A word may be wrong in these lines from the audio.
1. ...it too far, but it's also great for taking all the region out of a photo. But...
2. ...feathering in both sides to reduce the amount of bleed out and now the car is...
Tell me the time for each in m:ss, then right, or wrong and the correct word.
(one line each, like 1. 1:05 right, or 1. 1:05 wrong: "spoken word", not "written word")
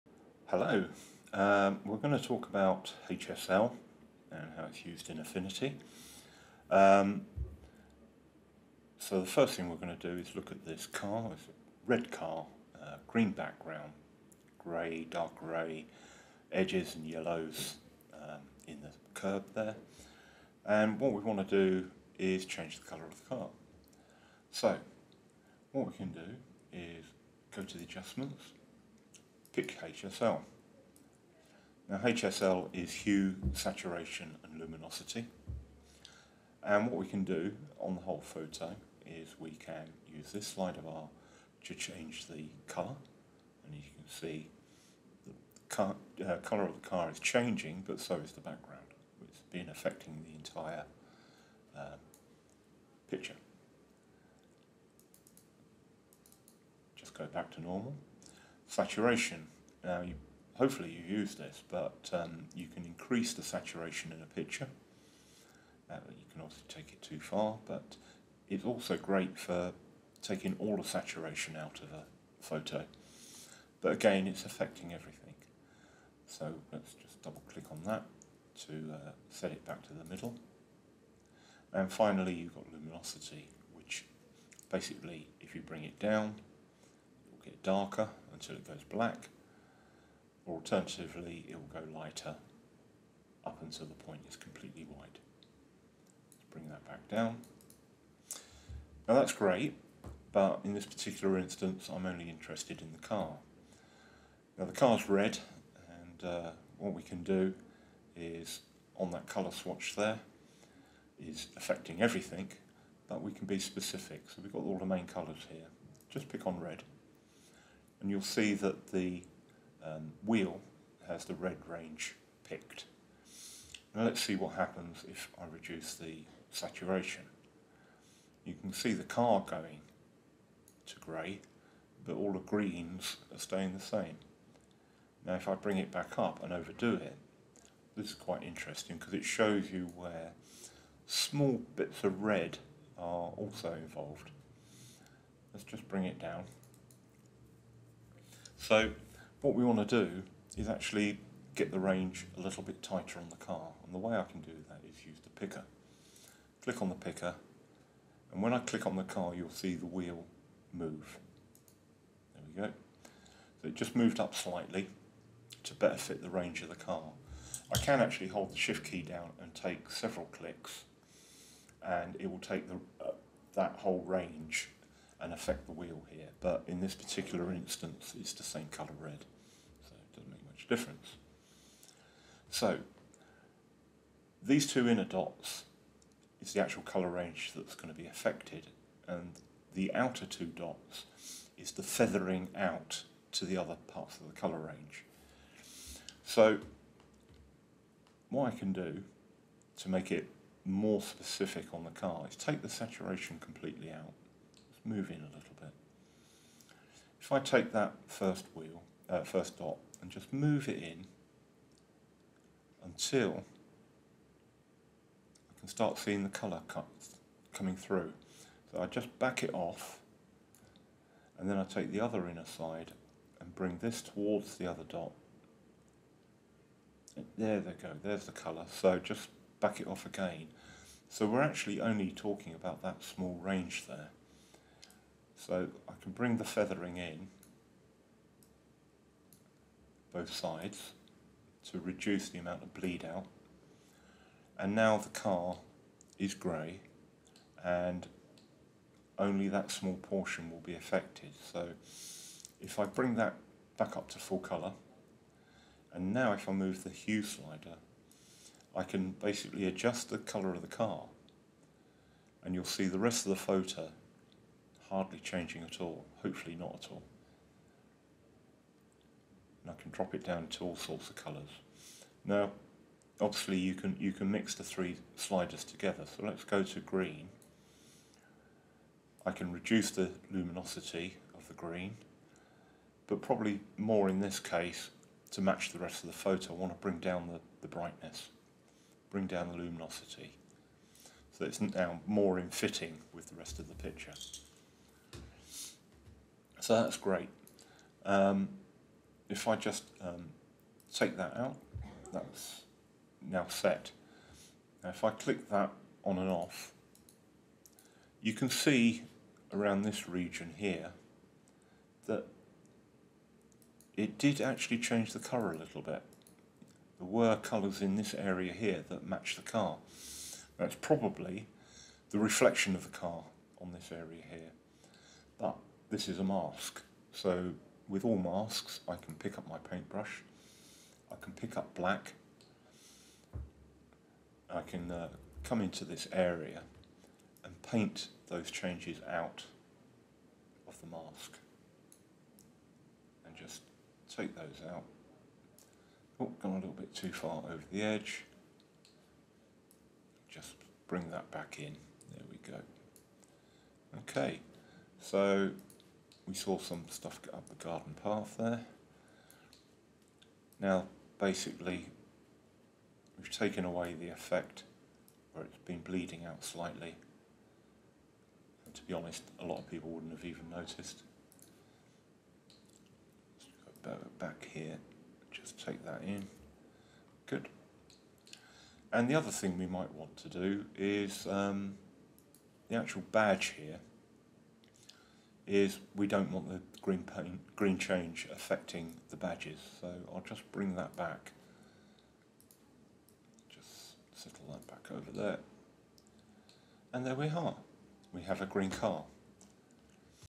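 1. 1:06 wrong: "saturation", not "region"
2. 3:56 right.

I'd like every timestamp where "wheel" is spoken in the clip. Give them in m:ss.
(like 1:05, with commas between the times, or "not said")
2:00, 2:39, 2:55, 3:28.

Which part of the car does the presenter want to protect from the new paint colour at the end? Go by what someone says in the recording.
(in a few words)
The badges.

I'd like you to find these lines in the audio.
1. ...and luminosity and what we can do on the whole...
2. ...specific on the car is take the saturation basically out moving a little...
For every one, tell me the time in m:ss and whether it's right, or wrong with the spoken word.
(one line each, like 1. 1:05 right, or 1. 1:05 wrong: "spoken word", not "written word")
1. 0:34 right
2. 3:21 wrong: "completely", not "basically".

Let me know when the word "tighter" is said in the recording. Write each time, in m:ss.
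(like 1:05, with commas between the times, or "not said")
2:32.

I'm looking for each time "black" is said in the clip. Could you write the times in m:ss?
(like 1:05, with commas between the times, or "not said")
1:28, 5:31.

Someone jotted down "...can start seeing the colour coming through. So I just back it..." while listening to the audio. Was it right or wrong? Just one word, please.
right.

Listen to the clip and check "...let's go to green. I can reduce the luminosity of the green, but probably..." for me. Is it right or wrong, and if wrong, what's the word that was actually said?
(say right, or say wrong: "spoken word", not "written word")
right.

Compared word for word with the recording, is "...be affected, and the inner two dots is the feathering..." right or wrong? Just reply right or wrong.
wrong.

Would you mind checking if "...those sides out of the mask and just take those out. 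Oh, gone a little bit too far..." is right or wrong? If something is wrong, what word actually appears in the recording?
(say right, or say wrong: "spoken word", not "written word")
wrong: "changes", not "sides".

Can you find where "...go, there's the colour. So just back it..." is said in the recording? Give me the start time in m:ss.
3:47.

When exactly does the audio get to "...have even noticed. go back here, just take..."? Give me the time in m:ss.
6:10.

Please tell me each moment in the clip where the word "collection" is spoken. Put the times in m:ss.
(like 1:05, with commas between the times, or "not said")
not said.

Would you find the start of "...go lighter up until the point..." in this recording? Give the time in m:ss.
1:31.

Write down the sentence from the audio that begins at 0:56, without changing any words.
Just go back to normal saturation.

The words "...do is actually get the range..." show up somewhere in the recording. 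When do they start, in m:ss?
2:30.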